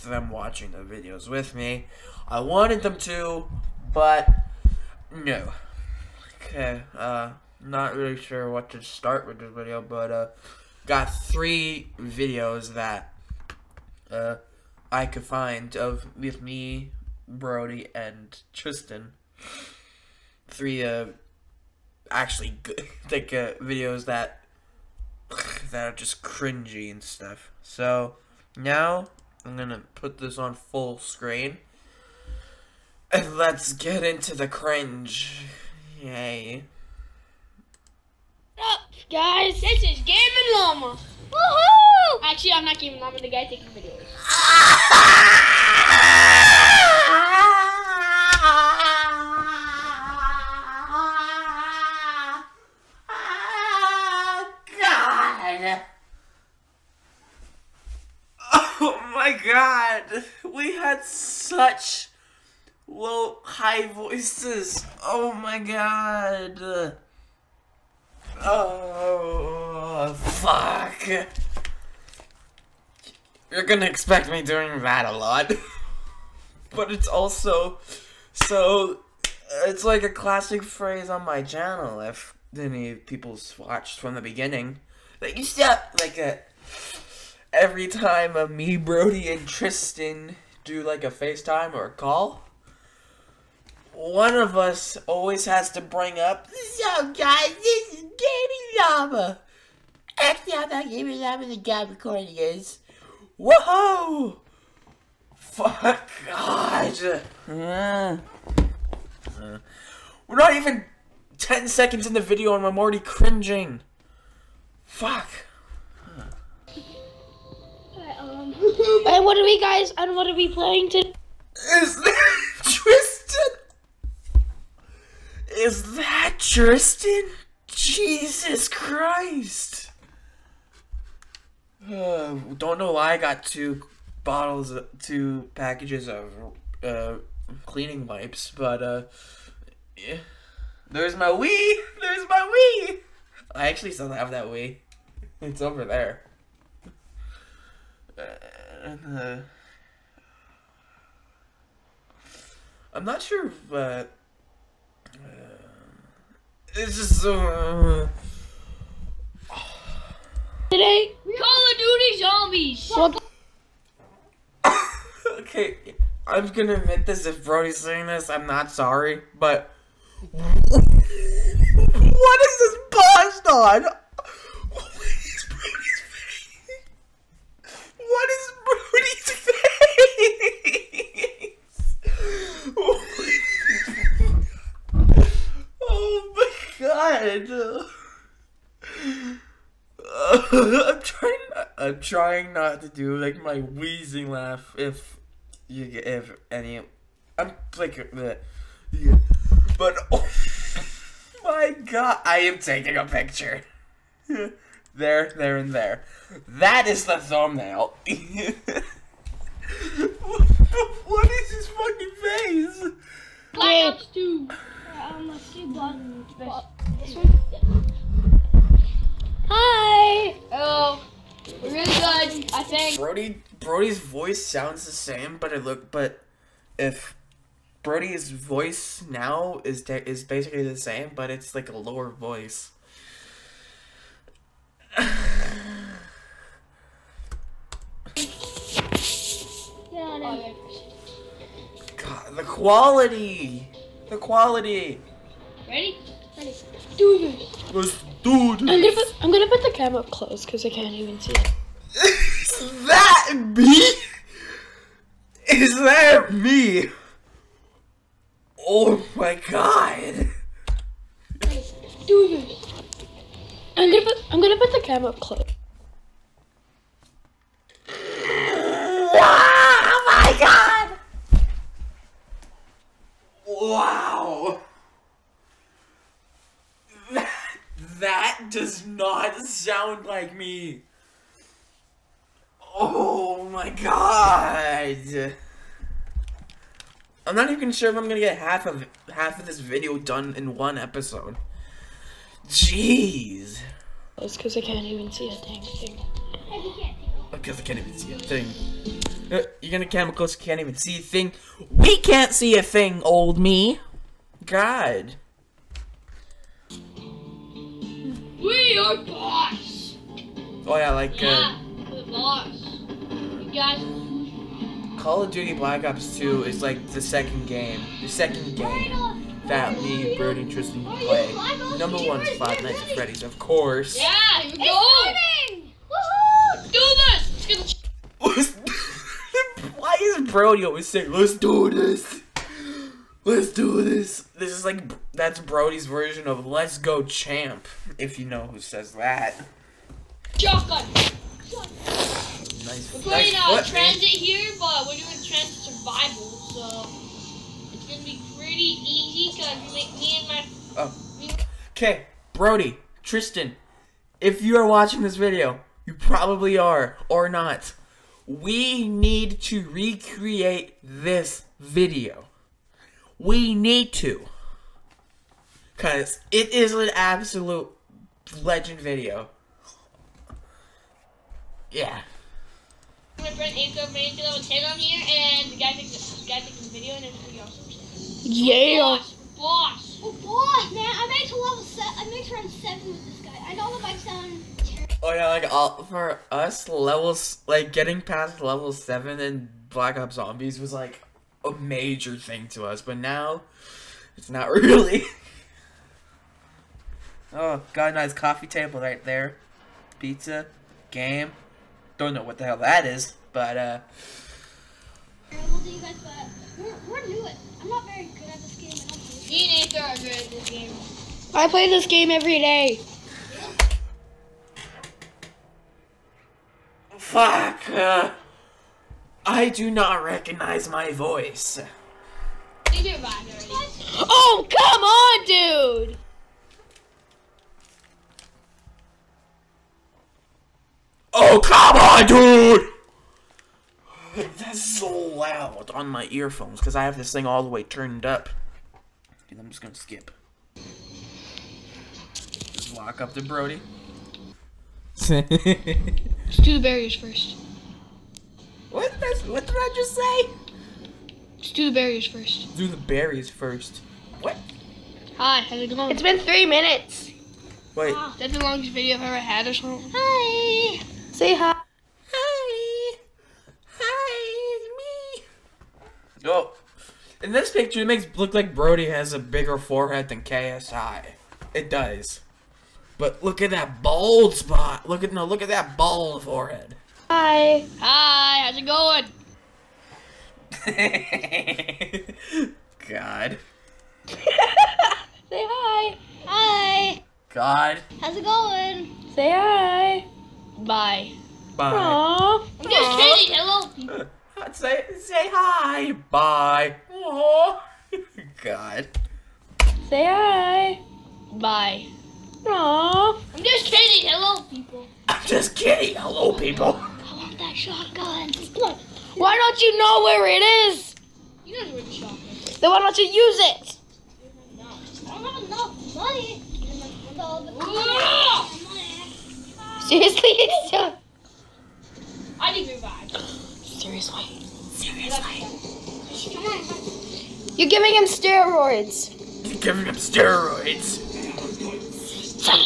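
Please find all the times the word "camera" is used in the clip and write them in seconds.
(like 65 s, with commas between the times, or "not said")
249 s, 264 s.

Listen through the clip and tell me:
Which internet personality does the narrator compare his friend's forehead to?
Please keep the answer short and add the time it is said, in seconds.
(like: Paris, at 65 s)
KSI, at 470 s.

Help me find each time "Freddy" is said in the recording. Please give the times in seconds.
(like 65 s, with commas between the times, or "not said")
322 s.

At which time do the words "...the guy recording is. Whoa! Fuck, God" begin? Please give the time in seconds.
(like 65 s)
101 s.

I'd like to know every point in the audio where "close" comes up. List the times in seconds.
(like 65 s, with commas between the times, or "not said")
250 s, 265 s.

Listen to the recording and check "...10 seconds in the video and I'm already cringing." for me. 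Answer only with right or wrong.
right.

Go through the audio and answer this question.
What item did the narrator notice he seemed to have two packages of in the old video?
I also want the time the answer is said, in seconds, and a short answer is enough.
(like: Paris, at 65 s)
Cleaning wipes, at 137 s.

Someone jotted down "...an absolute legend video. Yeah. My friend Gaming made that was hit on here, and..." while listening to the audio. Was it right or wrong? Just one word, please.
wrong.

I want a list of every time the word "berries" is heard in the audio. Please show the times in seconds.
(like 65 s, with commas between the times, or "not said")
452 s.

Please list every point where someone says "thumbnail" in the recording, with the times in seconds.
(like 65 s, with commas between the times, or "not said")
207 s.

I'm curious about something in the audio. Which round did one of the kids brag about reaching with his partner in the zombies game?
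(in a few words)
7.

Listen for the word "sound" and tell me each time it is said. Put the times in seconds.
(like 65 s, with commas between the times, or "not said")
224 s, 279 s, 383 s.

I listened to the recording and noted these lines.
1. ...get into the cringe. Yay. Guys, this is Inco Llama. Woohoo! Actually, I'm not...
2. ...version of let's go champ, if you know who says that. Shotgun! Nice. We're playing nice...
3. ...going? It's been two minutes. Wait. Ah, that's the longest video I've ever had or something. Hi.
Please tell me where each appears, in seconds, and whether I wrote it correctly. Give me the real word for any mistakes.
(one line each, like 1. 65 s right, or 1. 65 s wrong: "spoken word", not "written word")
1. 33 s wrong: "Gaming", not "Inco"
2. 335 s right
3. 455 s wrong: "three", not "two".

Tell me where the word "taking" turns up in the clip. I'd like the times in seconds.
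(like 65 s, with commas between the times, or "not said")
43 s, 202 s.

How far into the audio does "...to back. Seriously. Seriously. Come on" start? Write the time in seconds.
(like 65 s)
522 s.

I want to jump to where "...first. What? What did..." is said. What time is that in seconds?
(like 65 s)
446 s.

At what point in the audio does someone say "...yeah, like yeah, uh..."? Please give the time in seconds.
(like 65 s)
310 s.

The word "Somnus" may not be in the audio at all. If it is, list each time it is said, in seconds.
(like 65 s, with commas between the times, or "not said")
not said.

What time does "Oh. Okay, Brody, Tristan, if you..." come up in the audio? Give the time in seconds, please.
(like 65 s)
350 s.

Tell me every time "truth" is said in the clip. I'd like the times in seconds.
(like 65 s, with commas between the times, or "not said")
not said.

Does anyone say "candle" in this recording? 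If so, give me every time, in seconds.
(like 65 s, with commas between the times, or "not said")
not said.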